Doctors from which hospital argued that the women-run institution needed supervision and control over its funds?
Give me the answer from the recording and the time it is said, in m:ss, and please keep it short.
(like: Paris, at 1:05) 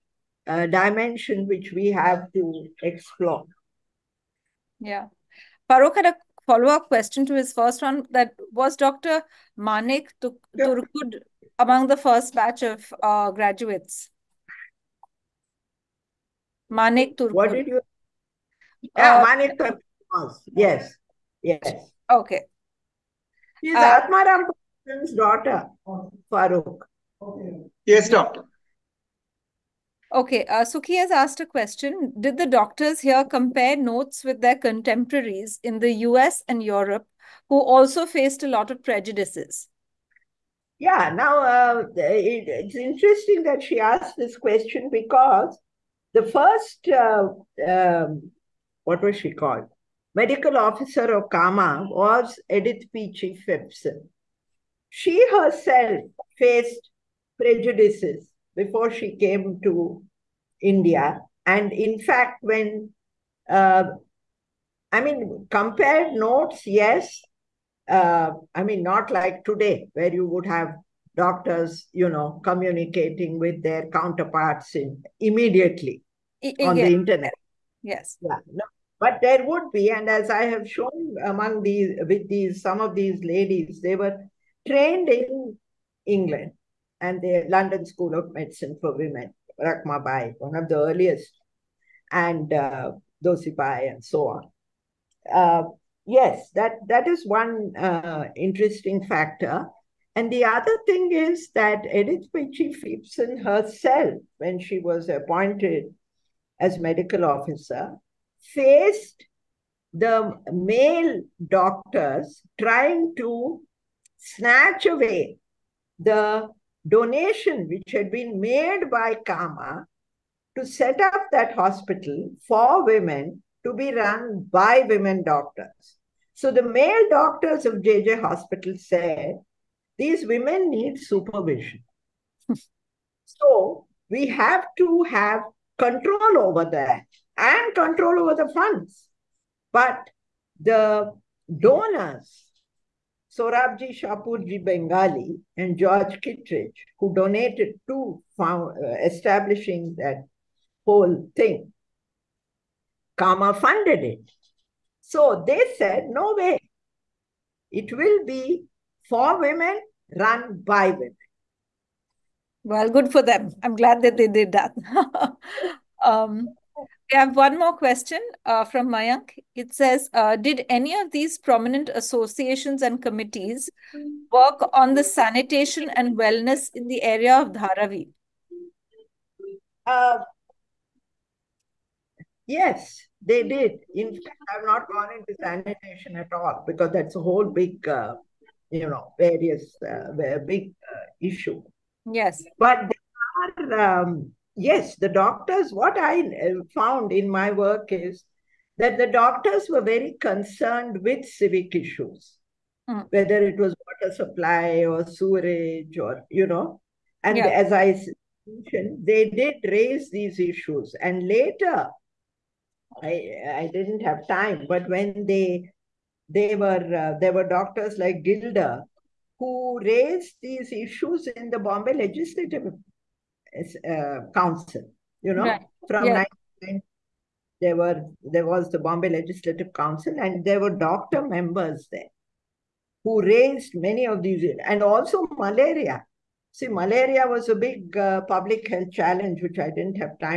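JJ Hospital, at 2:07.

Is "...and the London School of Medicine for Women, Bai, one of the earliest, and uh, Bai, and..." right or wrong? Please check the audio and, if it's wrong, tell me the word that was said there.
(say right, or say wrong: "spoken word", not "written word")
right.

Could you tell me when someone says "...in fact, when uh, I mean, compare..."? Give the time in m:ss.
1:01.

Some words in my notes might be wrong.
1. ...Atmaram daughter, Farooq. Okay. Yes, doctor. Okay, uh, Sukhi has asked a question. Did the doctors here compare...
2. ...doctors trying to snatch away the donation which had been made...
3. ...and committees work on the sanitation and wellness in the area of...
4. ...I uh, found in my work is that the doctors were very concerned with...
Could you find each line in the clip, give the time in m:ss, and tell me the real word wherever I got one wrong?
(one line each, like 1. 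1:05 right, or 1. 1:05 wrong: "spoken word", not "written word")
1. 0:24 right
2. 1:51 right
3. 2:52 right
4. 3:15 right.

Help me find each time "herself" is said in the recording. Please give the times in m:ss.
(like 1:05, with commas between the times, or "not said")
0:55, 1:43.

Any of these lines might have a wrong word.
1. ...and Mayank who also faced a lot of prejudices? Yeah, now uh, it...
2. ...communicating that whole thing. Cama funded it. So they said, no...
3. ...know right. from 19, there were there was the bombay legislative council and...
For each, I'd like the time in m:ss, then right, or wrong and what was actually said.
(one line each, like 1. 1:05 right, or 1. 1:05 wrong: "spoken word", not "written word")
1. 0:36 wrong: "Europe", not "Mayank"
2. 2:29 wrong: "establishing", not "communicating"
3. 3:45 right.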